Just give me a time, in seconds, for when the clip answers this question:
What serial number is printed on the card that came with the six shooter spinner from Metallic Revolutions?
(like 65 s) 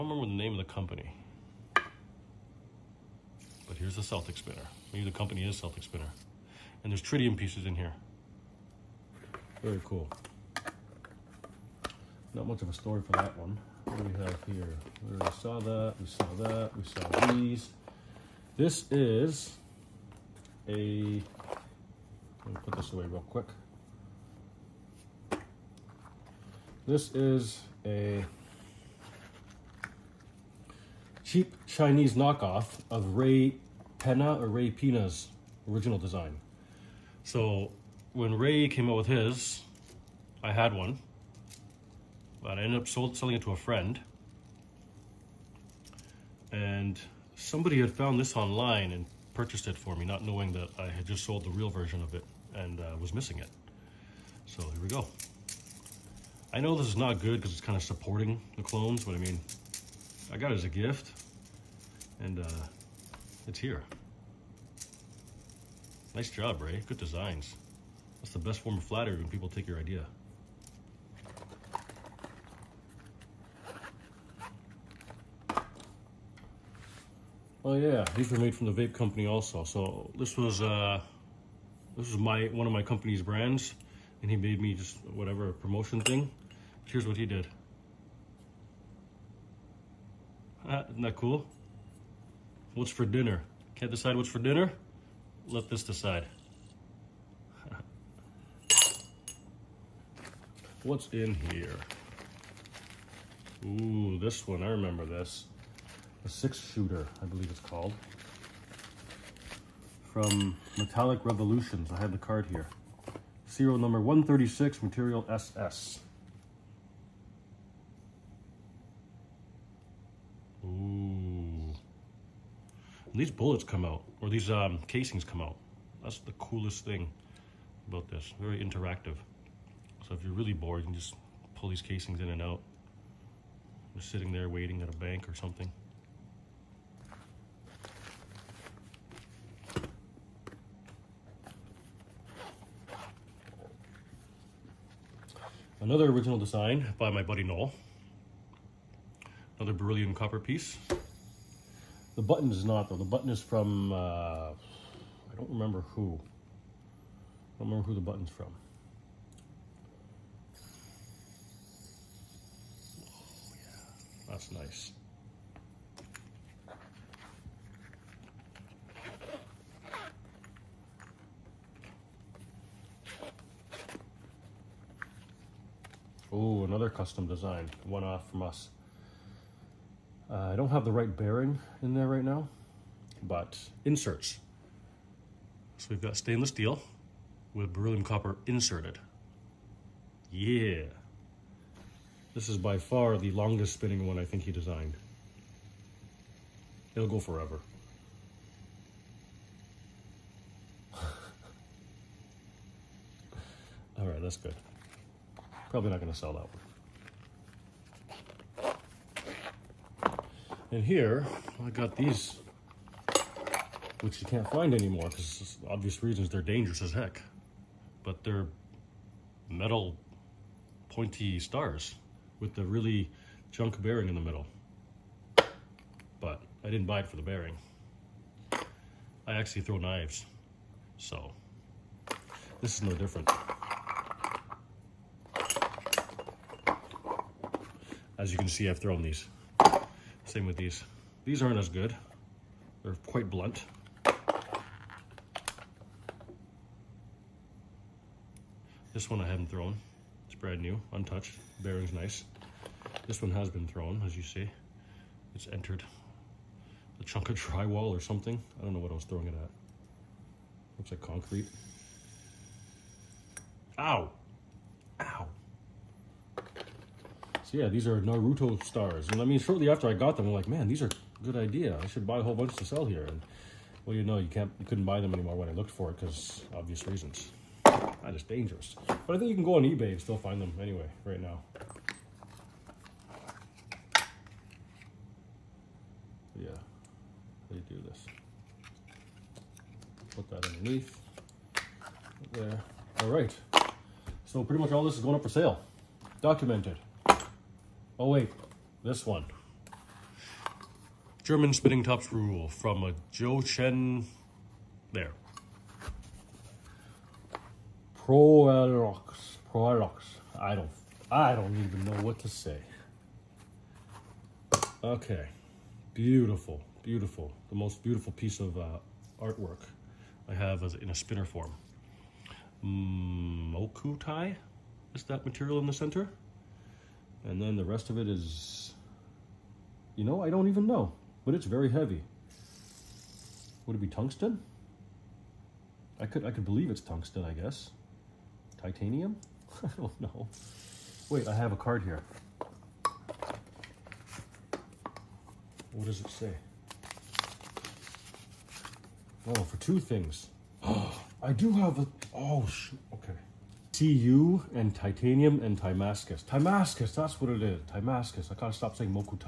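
113 s.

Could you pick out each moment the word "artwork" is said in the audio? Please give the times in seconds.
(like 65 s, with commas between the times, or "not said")
319 s.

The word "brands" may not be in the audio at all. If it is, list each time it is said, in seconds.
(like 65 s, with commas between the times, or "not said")
83 s, 250 s.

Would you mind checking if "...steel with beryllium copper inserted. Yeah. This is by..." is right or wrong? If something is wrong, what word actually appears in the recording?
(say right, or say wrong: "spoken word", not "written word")
right.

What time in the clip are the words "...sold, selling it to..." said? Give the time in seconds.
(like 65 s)
42 s.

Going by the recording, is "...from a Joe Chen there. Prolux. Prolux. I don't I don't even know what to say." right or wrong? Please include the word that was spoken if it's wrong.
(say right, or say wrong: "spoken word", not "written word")
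right.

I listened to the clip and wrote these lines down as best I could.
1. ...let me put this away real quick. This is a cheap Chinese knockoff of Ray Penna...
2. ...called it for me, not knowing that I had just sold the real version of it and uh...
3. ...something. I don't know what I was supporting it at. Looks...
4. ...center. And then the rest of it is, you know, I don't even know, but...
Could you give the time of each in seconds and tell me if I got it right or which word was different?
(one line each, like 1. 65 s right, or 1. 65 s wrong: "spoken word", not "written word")
1. 22 s right
2. 49 s wrong: "purchased", not "called"
3. 257 s wrong: "throwing", not "supporting"
4. 325 s right.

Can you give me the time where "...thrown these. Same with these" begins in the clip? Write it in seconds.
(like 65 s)
238 s.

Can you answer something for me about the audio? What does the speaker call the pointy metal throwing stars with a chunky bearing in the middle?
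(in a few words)
Naruto stars.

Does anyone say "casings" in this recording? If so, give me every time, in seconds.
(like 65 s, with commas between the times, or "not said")
124 s, 131 s.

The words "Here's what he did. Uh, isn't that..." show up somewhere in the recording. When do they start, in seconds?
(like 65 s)
86 s.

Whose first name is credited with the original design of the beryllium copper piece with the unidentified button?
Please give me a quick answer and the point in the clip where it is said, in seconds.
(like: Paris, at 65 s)
Noel, at 147 s.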